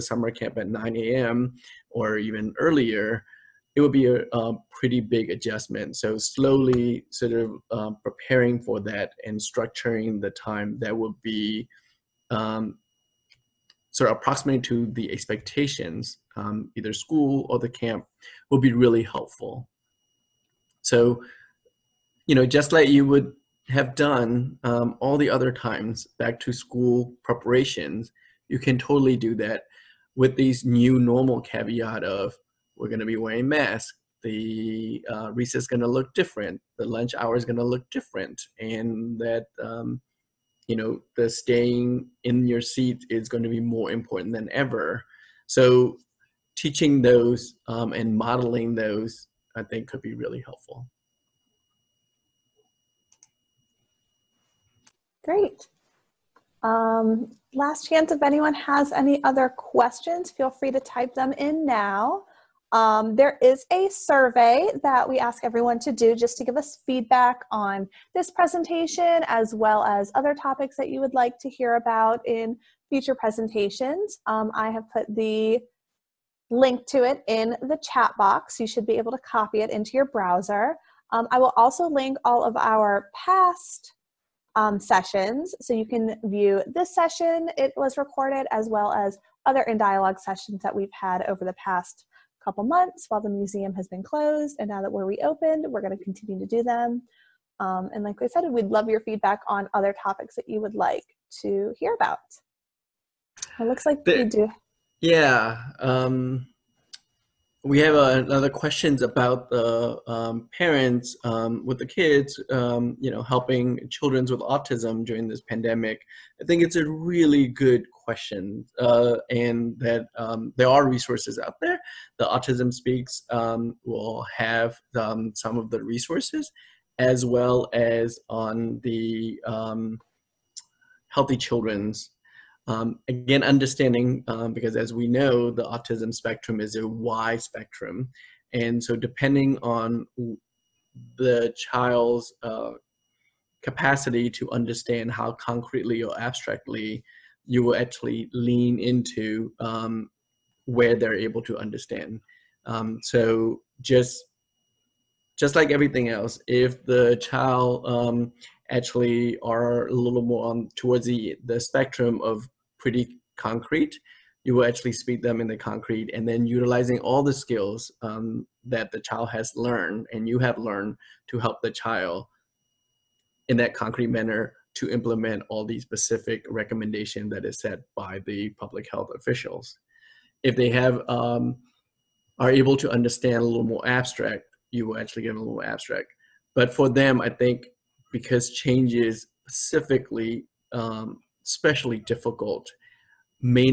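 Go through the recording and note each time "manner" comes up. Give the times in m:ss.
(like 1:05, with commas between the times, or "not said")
2:54.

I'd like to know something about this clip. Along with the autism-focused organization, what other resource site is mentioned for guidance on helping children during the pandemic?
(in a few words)
Healthy Children.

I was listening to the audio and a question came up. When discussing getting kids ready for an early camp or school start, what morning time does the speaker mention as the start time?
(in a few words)
9 a.m.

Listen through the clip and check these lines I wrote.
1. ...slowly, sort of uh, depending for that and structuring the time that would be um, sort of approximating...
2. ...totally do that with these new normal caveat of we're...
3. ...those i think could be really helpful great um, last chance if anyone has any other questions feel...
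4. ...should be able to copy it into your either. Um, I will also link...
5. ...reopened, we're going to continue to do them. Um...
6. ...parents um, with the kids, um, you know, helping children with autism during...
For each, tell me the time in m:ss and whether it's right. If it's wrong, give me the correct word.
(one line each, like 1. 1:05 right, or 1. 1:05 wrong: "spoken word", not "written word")
1. 0:06 wrong: "preparing", not "depending"
2. 0:28 right
3. 0:48 right
4. 1:18 wrong: "browser", not "either"
5. 1:35 right
6. 1:50 right.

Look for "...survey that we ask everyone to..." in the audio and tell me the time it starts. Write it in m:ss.
1:03.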